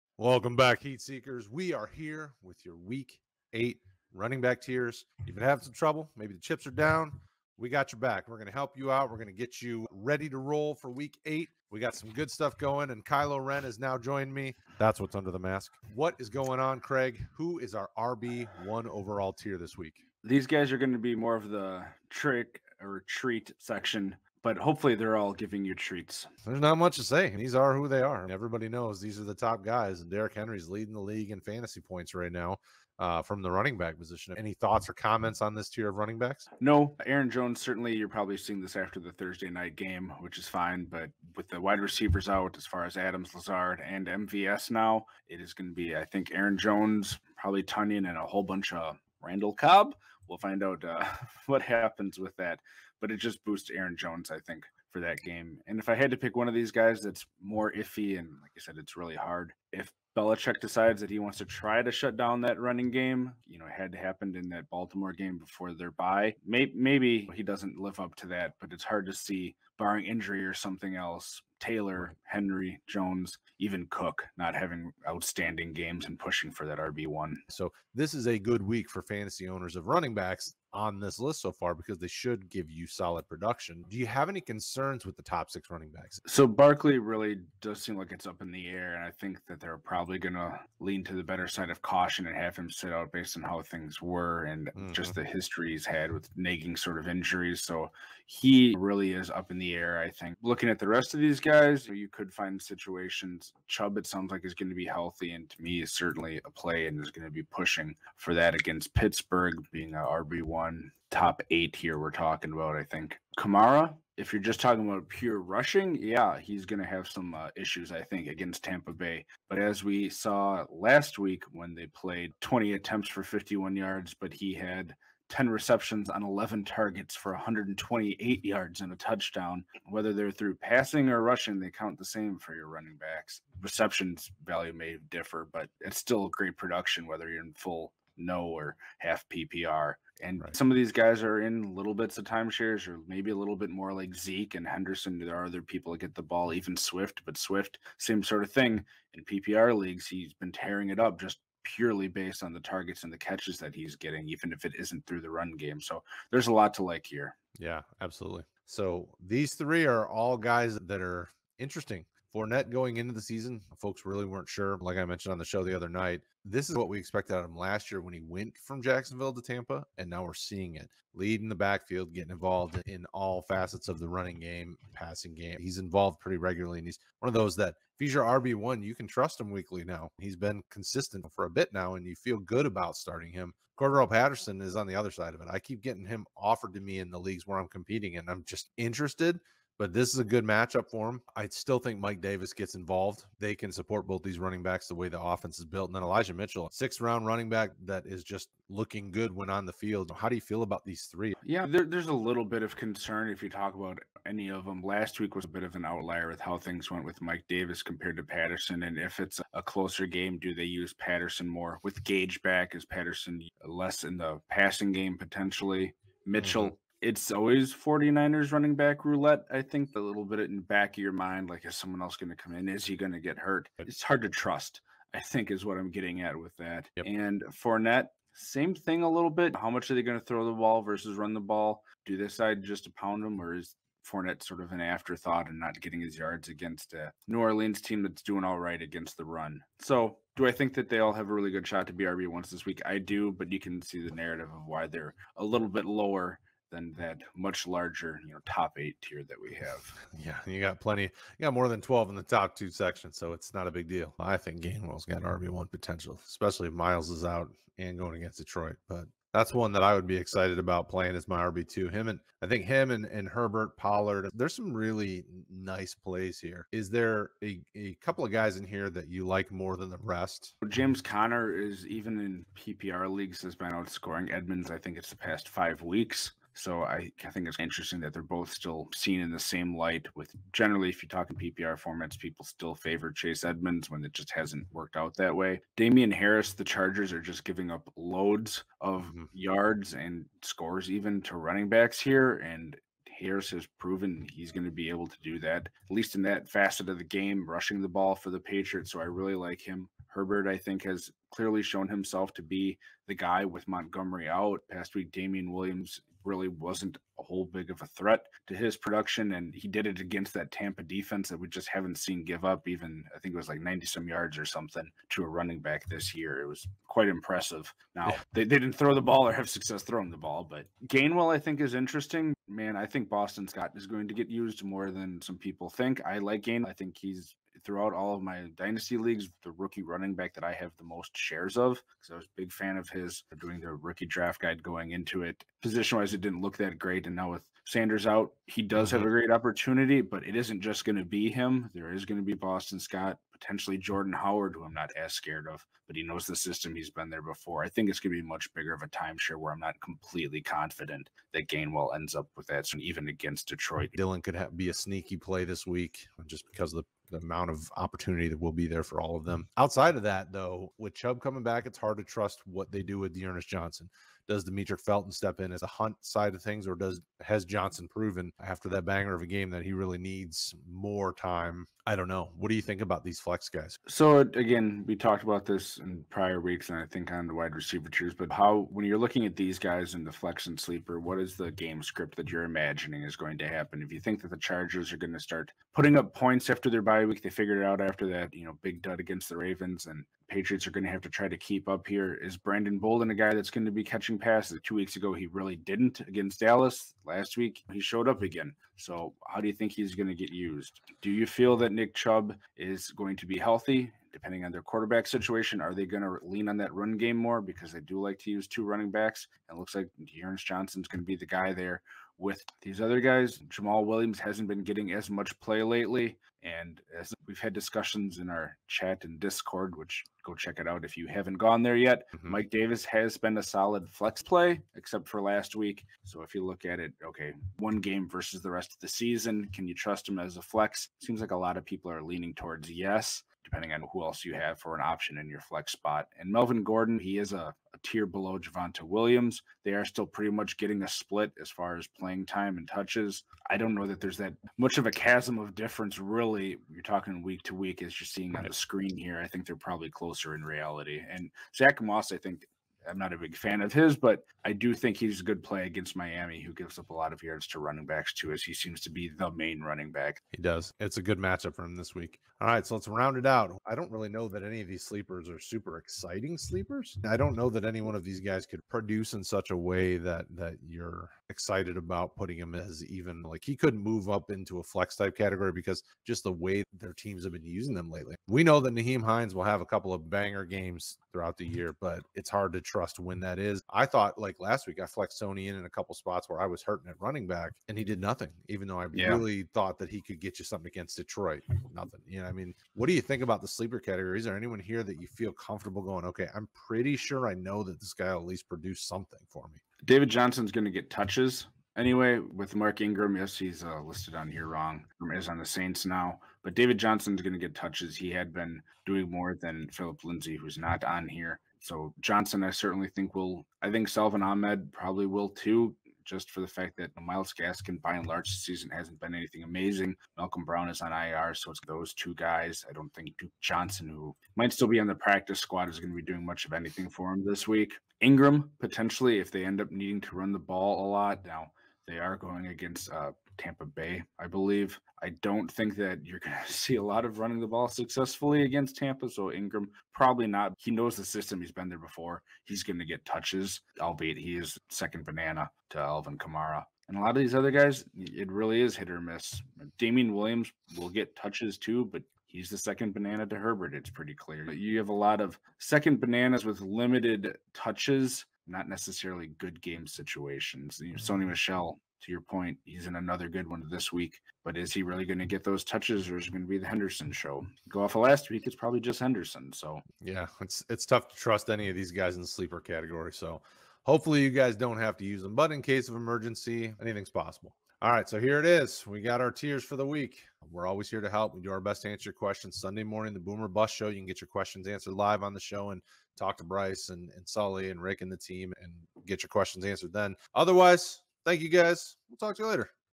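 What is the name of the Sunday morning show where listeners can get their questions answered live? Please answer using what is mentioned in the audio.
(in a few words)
Boomer Bus Show.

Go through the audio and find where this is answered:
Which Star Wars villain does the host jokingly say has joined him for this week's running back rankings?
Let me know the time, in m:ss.
0:13.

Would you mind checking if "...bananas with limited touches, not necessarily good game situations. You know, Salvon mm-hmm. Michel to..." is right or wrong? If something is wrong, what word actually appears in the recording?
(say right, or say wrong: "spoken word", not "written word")
wrong: "Sony", not "Salvon".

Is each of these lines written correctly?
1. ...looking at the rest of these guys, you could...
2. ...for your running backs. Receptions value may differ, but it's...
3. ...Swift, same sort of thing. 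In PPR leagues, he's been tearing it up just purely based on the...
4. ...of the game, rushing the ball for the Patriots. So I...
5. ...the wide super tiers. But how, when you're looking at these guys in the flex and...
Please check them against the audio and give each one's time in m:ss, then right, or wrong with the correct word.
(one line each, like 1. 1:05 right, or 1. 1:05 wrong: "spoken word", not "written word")
1. 1:40 right
2. 2:12 right
3. 2:27 right
4. 4:56 right
5. 6:17 wrong: "receiver", not "super".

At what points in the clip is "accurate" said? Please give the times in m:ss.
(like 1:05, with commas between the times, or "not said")
not said.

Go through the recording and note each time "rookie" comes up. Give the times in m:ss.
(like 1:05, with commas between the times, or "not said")
5:29, 5:33.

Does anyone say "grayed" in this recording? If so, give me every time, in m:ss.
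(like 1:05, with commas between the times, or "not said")
not said.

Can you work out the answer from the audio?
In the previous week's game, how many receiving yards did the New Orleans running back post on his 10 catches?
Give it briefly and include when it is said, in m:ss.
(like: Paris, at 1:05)
128, at 2:07.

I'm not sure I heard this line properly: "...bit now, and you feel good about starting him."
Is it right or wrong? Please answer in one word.
right.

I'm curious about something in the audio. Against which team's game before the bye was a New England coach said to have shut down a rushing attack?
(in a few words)
Baltimore.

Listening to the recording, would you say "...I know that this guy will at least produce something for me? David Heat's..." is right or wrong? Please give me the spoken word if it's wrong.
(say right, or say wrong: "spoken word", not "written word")
wrong: "Johnson", not "Heat".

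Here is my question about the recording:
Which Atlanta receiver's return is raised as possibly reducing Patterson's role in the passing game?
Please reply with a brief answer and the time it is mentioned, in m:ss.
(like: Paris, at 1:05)
Gage, at 3:32.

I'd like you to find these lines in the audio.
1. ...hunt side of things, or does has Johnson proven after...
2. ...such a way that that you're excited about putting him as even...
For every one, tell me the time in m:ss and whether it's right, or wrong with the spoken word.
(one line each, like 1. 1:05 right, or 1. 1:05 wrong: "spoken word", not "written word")
1. 6:05 right
2. 7:49 right.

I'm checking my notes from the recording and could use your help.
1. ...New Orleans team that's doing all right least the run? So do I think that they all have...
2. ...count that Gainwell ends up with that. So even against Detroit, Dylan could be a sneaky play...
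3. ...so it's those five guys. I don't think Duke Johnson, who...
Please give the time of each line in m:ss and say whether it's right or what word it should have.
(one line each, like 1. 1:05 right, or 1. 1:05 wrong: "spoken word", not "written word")
1. 3:57 wrong: "against", not "least"
2. 5:50 wrong: "confident", not "count"
3. 8:41 wrong: "two", not "five".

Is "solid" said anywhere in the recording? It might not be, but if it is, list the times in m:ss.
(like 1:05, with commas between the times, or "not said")
1:22, 7:03.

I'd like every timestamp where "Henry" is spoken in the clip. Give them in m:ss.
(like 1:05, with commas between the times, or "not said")
0:30, 1:12.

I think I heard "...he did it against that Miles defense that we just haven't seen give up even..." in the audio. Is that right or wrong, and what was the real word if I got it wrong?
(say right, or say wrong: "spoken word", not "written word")
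wrong: "Tampa", not "Miles".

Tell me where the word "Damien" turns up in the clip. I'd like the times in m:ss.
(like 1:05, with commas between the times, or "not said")
4:45, 5:05, 9:09.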